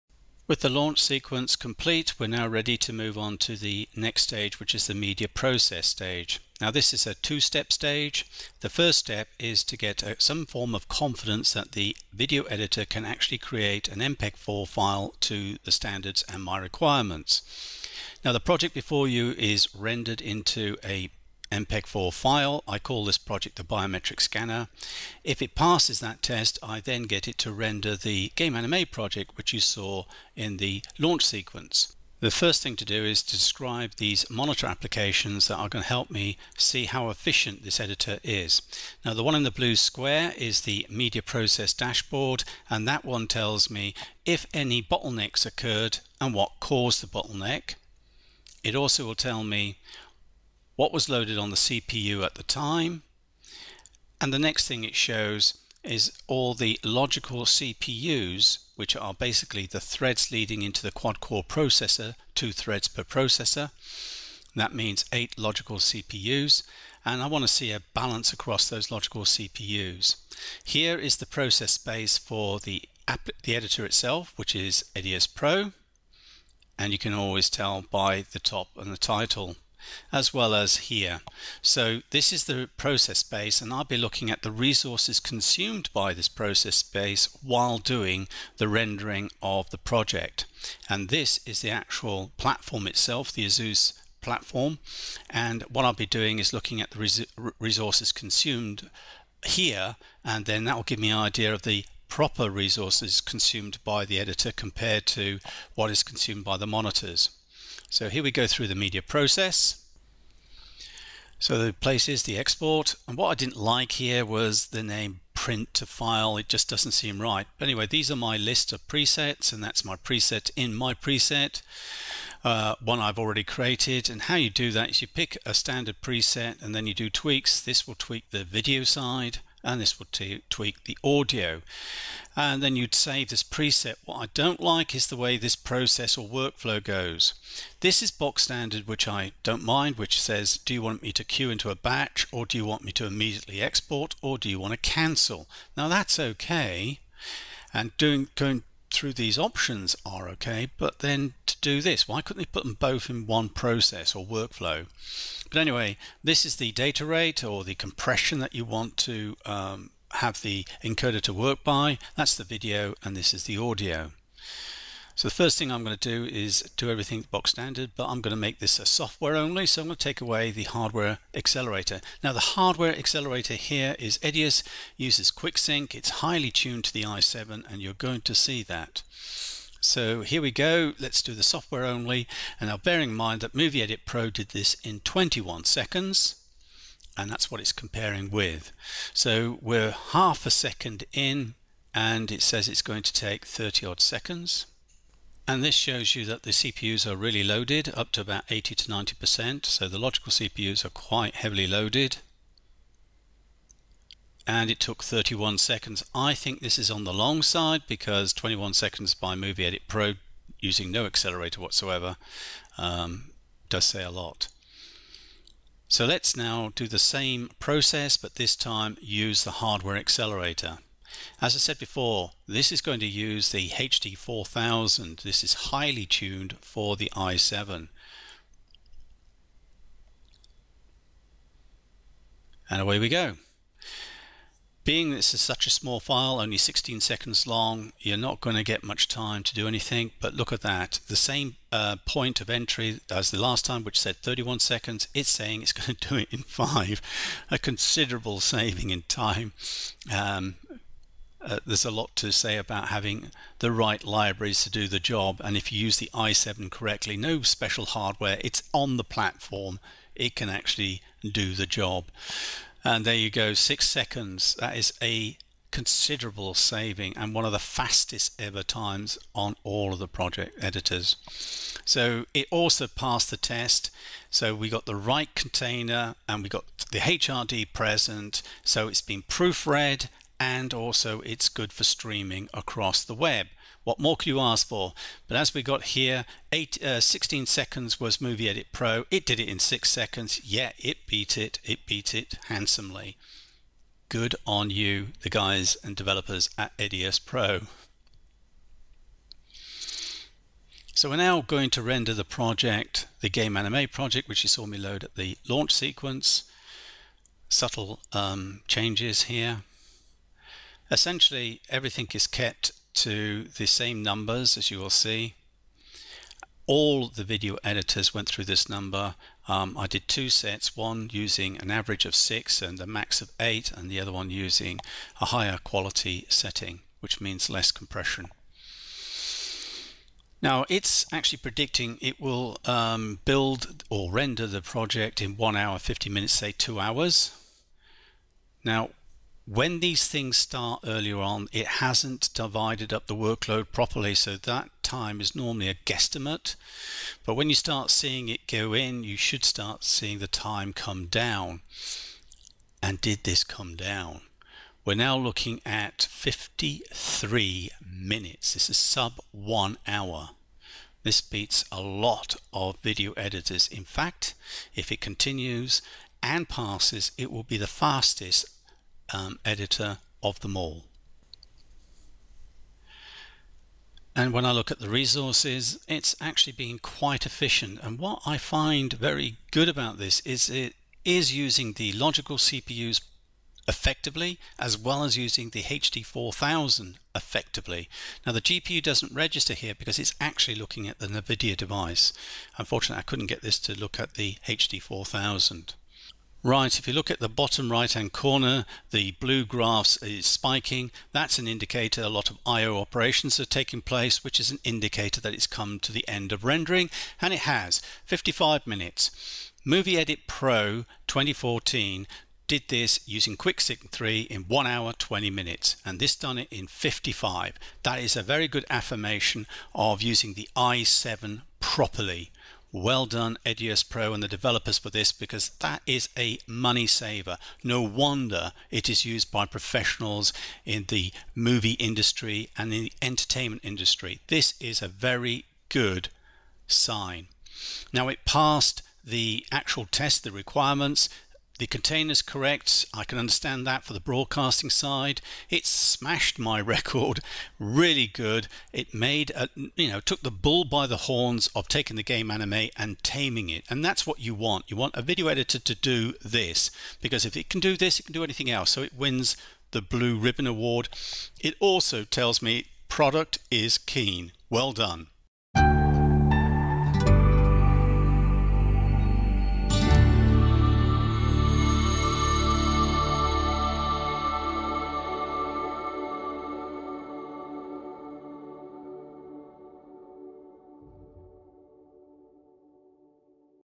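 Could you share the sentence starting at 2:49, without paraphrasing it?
So I'm going to take away the hardware accelerator.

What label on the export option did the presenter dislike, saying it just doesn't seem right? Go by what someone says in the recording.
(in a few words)
print to file.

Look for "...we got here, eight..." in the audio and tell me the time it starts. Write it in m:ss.
4:45.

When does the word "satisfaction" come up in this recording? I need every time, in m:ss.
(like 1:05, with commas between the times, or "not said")
not said.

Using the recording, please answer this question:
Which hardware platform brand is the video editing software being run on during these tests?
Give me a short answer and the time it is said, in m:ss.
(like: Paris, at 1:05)
Asus, at 1:33.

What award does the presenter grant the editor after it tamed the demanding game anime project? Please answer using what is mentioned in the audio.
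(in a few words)
Blue Ribbon Award.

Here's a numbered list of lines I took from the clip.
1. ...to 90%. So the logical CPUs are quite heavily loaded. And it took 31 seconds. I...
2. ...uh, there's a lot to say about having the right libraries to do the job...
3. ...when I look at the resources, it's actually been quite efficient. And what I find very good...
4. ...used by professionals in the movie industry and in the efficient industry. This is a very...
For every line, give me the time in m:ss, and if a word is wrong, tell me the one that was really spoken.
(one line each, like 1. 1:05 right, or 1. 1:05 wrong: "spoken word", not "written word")
1. 3:18 right
2. 4:11 right
3. 6:14 right
4. 7:09 wrong: "entertainment", not "efficient".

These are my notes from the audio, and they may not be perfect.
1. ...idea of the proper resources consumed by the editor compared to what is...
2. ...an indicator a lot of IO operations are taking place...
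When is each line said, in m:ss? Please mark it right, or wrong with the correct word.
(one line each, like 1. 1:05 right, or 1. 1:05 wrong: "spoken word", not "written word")
1. 1:41 right
2. 6:41 right.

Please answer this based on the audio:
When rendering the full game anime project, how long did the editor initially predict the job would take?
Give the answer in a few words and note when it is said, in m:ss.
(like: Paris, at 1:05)
1 hour 50 minutes, at 5:35.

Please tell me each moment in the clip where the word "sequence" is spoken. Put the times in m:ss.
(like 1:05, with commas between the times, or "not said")
0:01, 0:31, 5:05.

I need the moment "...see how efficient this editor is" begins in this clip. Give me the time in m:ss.
0:36.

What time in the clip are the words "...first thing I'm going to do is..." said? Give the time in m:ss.
2:45.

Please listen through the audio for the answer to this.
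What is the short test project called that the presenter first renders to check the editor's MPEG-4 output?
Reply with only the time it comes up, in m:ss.
0:23.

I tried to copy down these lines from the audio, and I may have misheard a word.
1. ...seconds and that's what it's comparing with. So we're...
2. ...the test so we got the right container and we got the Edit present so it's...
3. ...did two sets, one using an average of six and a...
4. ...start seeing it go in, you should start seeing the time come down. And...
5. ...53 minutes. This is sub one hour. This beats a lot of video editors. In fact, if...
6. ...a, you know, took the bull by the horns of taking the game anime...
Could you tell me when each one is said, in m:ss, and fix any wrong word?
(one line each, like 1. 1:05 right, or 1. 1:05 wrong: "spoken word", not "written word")
1. 3:05 right
2. 4:33 wrong: "HRD", not "Edit"
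3. 5:19 right
4. 5:47 right
5. 5:56 right
6. 7:29 right.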